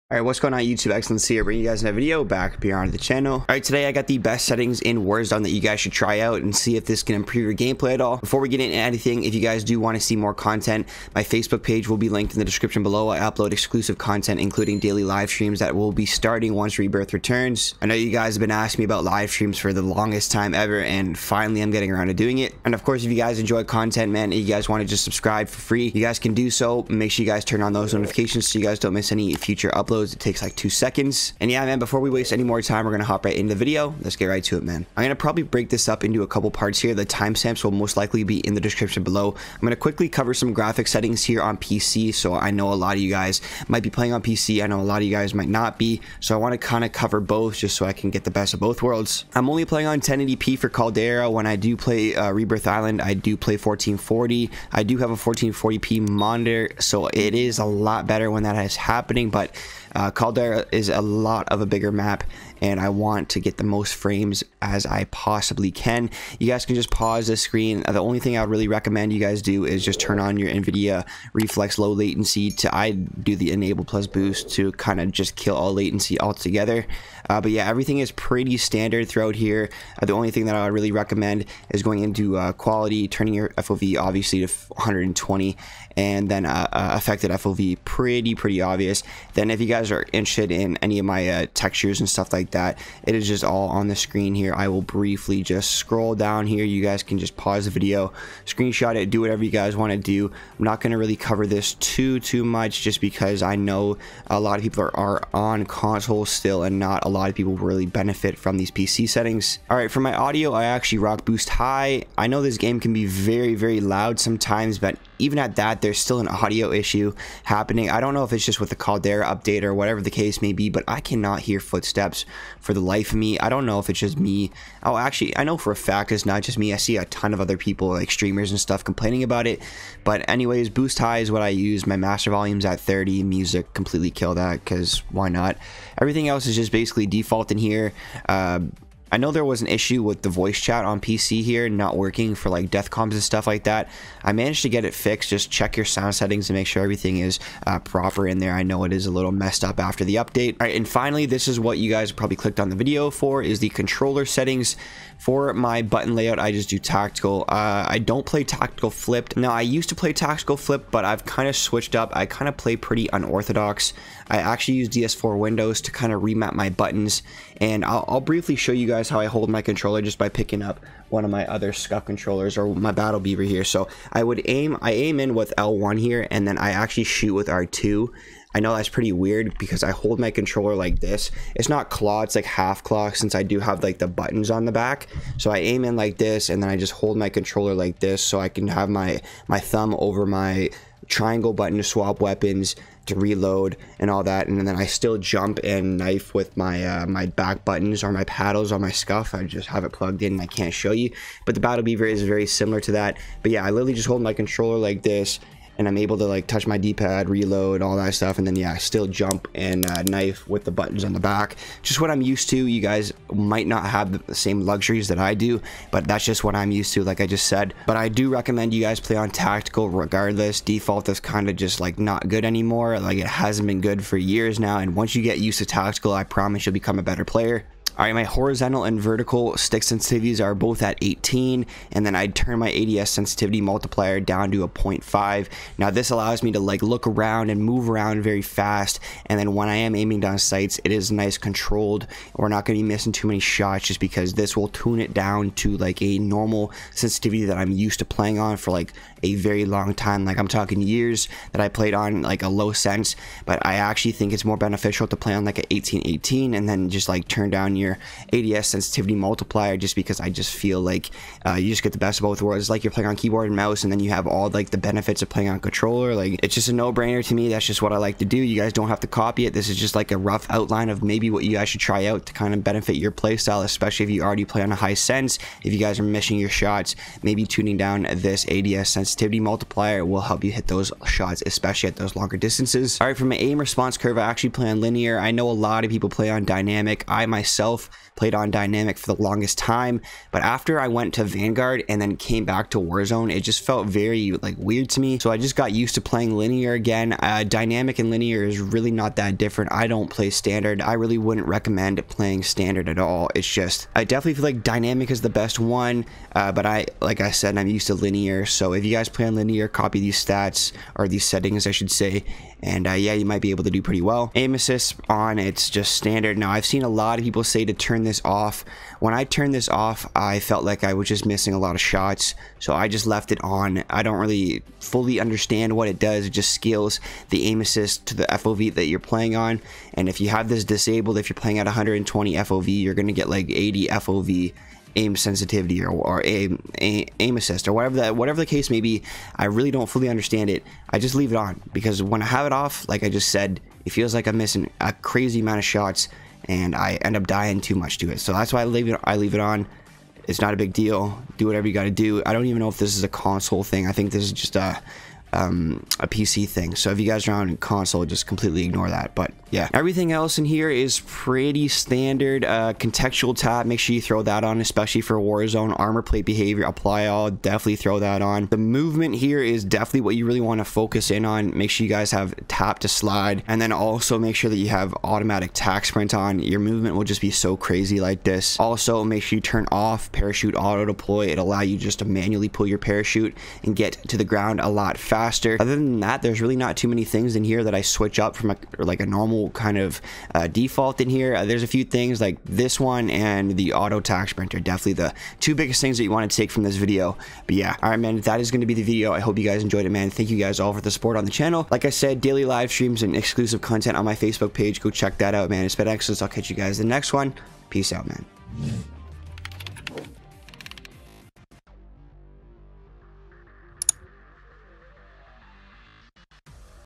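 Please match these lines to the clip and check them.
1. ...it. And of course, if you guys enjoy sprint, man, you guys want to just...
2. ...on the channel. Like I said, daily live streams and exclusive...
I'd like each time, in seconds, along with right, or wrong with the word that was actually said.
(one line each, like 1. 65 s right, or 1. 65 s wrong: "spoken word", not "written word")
1. 22 s wrong: "content", not "sprint"
2. 401 s right.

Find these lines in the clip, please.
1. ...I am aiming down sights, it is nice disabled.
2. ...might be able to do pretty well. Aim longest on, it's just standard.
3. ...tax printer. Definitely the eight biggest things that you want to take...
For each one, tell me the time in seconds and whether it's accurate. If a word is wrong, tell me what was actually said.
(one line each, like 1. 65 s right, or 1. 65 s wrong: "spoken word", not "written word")
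1. 239 s wrong: "controlled", not "disabled"
2. 313 s wrong: "assist", not "longest"
3. 393 s wrong: "two", not "eight".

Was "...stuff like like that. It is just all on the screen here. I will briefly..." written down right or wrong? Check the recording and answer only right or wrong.
right.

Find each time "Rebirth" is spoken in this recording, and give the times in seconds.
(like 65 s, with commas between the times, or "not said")
16 s, 52 s.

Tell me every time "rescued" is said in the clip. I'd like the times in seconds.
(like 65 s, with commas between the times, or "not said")
not said.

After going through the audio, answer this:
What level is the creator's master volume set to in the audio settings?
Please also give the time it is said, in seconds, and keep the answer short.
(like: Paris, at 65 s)
30, at 132 s.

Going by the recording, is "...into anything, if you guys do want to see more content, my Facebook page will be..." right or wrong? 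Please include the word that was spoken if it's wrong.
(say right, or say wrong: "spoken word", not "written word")
right.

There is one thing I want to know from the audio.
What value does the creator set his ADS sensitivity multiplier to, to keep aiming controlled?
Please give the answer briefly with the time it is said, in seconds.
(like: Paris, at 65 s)
0.5, at 234 s.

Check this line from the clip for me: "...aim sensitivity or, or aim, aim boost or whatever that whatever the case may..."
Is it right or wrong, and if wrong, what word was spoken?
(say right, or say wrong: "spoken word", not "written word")
wrong: "assist", not "boost".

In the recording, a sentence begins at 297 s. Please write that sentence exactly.
Uh, dynamic and linear is really not that different.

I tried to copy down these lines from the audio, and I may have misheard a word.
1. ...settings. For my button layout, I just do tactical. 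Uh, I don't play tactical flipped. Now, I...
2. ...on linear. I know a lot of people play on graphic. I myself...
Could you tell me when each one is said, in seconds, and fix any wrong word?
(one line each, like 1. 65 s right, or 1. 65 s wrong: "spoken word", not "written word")
1. 154 s right
2. 284 s wrong: "dynamic", not "graphic".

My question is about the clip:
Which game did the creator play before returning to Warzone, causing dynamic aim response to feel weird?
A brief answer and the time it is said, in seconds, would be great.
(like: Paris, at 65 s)
Vanguard, at 291 s.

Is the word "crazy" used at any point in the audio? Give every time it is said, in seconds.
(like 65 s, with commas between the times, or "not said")
344 s, 377 s.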